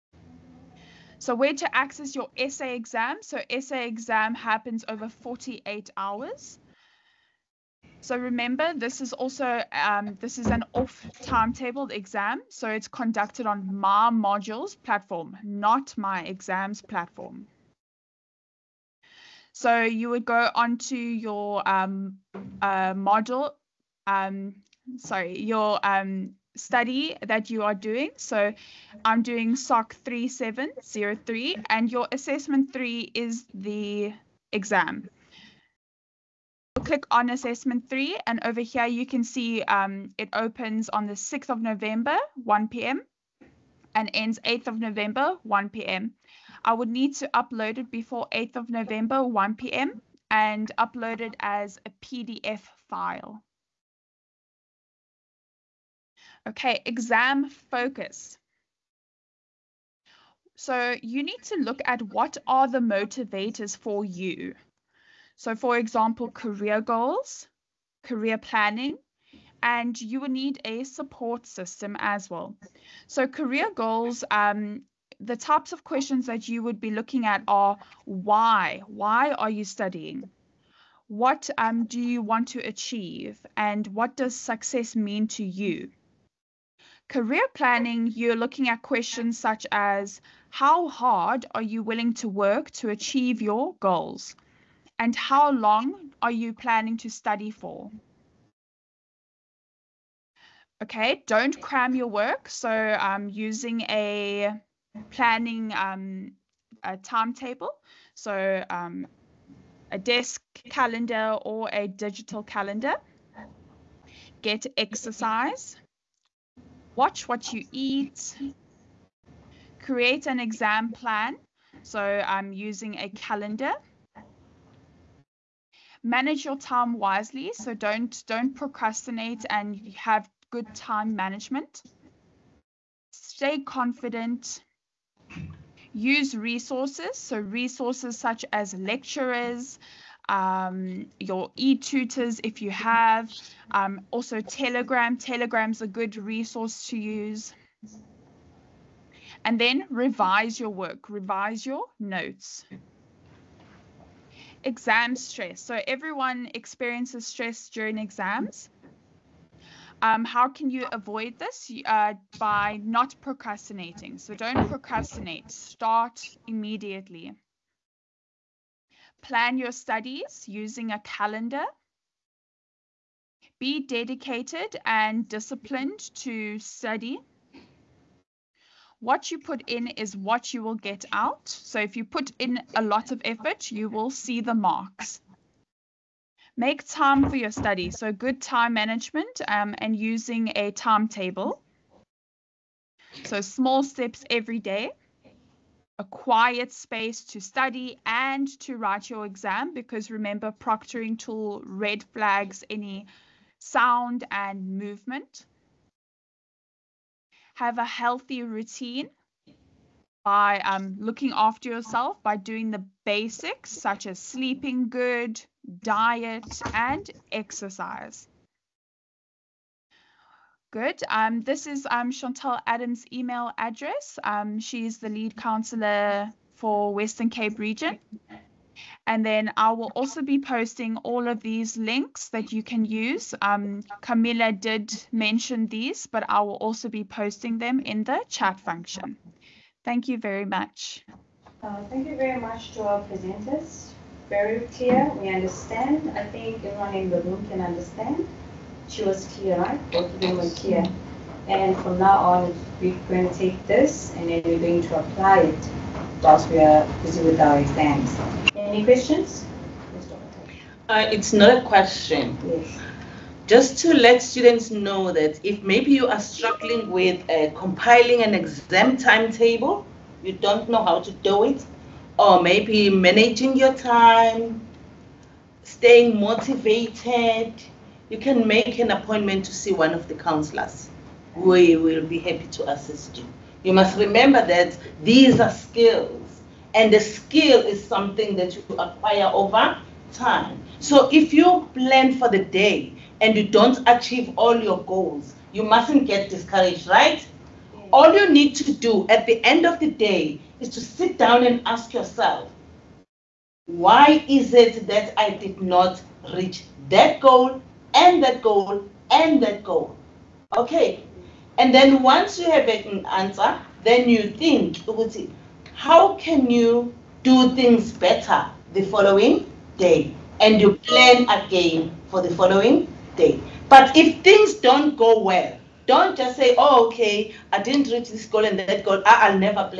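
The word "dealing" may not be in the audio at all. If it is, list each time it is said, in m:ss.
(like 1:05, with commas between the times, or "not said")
not said.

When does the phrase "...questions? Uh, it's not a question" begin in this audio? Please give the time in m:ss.
4:18.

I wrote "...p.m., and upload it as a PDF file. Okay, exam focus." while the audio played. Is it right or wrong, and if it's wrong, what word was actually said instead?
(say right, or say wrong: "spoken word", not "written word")
right.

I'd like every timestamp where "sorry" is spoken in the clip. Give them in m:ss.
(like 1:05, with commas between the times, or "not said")
0:24.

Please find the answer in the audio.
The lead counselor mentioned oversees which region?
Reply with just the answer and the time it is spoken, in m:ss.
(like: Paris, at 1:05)
Western Cape, at 3:46.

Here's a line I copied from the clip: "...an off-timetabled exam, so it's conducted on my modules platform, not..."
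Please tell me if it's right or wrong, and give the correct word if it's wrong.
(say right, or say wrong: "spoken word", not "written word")
right.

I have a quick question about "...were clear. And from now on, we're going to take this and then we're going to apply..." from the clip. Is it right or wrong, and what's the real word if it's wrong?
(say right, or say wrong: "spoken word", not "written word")
right.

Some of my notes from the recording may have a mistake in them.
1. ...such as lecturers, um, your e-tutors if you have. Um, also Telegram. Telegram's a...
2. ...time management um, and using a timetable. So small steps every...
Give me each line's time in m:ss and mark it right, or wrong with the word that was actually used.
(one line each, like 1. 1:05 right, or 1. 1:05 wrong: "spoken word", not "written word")
1. 2:18 right
2. 3:08 right.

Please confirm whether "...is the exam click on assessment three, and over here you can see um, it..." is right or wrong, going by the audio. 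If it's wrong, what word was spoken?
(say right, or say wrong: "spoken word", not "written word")
right.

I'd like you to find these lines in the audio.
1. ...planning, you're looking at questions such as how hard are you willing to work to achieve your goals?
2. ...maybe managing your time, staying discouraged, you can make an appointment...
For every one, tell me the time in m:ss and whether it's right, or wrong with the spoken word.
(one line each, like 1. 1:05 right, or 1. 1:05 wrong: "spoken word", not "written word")
1. 1:27 right
2. 4:32 wrong: "motivated", not "discouraged".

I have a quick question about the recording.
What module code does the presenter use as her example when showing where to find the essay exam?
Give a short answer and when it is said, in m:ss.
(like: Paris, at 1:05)
SOC 3703, at 0:29.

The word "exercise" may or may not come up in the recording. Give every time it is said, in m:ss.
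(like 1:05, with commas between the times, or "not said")
1:54, 3:37.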